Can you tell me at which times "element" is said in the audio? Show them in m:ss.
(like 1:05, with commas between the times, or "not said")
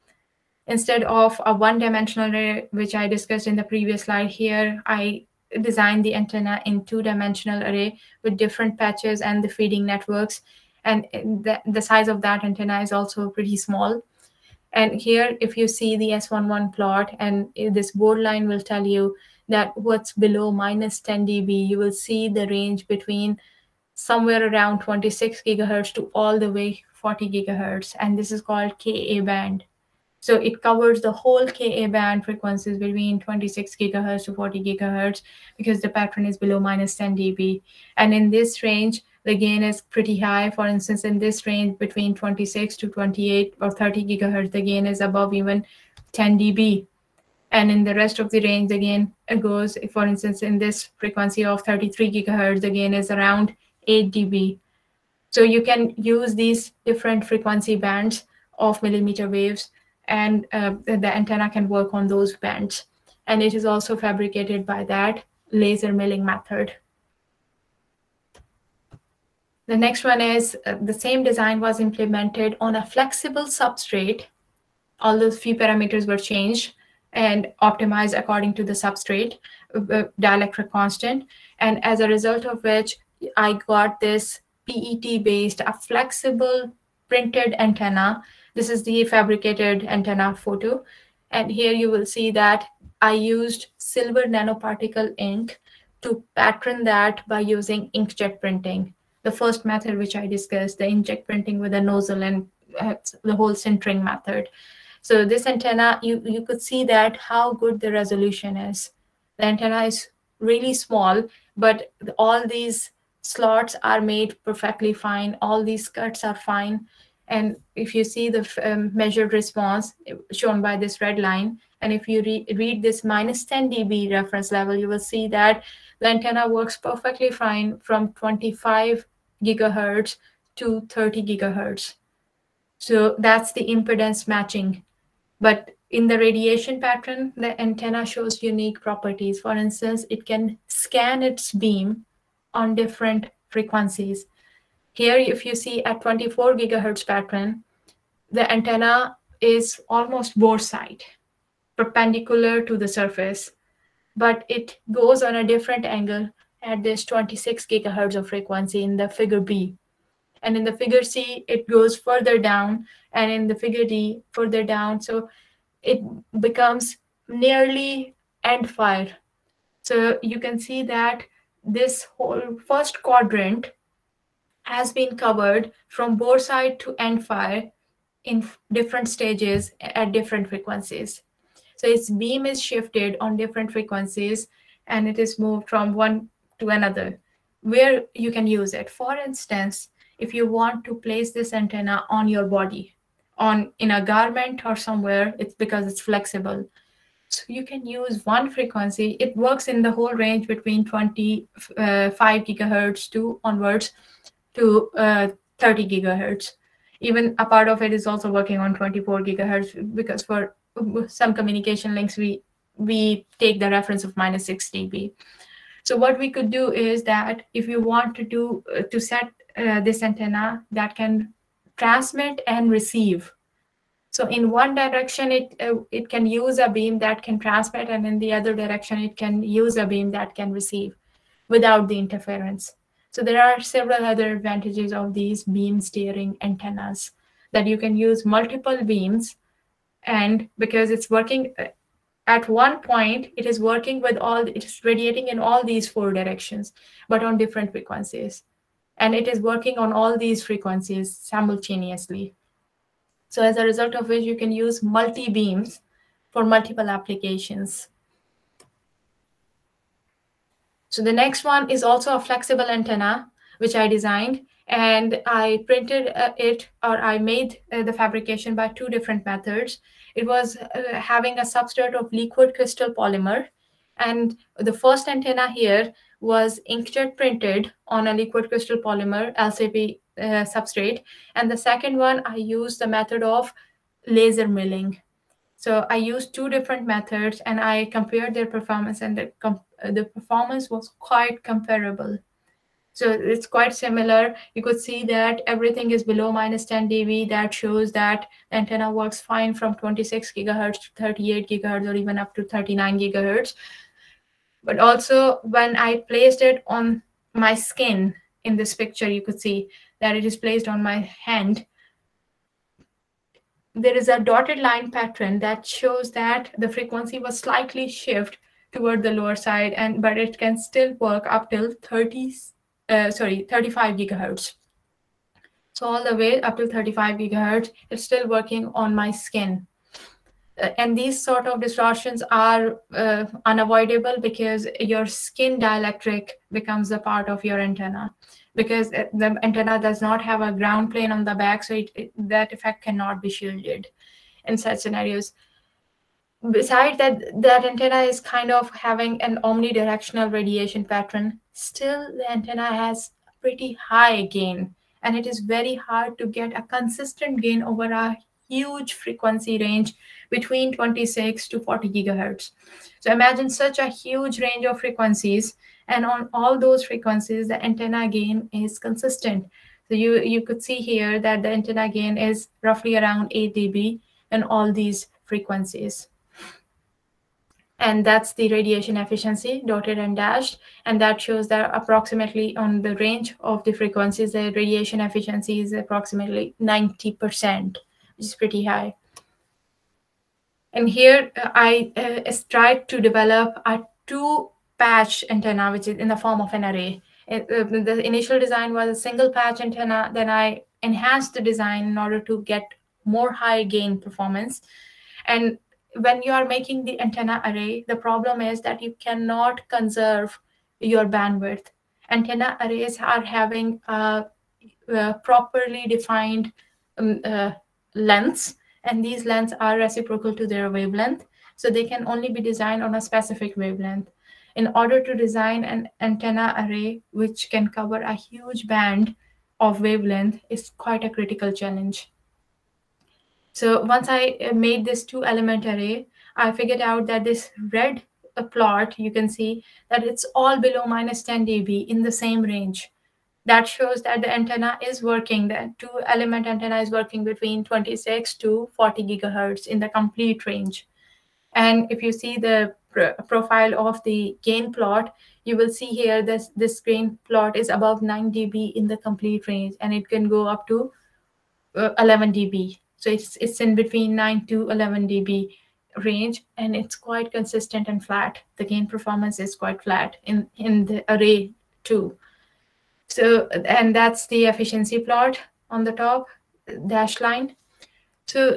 7:15, 7:26.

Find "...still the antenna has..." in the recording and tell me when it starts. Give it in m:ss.
5:51.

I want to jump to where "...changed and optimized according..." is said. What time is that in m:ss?
1:16.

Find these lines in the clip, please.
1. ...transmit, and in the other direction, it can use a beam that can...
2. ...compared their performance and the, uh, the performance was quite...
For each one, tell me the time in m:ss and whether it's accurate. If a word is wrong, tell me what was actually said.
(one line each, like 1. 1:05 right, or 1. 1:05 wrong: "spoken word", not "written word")
1. 3:47 right
2. 4:47 right.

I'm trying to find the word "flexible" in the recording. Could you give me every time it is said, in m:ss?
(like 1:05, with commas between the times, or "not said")
1:12, 1:25, 3:16, 4:22.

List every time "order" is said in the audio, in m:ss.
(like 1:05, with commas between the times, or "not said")
6:41, 7:04.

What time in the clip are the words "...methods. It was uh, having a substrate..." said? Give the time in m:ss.
4:29.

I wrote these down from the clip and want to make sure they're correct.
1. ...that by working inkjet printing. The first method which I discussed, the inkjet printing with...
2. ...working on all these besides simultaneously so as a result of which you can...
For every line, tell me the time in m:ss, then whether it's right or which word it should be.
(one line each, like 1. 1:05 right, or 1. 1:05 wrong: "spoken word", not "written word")
1. 1:36 wrong: "using", not "working"
2. 4:09 wrong: "frequencies", not "besides".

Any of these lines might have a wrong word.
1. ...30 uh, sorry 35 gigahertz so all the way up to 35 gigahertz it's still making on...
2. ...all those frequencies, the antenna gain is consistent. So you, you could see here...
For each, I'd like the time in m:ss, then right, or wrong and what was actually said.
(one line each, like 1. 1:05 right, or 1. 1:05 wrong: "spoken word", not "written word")
1. 5:21 wrong: "working", not "making"
2. 6:06 right.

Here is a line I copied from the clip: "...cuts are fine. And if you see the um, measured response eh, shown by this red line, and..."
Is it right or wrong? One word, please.
right.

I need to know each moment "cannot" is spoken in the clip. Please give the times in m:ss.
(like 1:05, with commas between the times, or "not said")
5:42, 6:48.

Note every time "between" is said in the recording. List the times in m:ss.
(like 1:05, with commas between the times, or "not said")
0:22, 0:32, 0:41, 3:20, 6:00, 7:27, 7:43.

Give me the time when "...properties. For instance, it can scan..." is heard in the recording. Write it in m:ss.
2:18.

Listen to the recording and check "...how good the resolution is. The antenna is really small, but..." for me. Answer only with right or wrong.
right.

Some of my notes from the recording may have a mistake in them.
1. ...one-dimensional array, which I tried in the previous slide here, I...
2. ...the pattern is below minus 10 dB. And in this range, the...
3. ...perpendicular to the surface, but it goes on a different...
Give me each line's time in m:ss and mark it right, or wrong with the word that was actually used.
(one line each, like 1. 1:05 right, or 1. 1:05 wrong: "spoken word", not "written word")
1. 0:01 wrong: "discussed", not "tried"
2. 0:35 right
3. 2:31 right.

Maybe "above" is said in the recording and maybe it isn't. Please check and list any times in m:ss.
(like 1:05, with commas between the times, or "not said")
0:45, 7:37.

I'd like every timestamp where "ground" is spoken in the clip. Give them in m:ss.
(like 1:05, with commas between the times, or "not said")
5:40.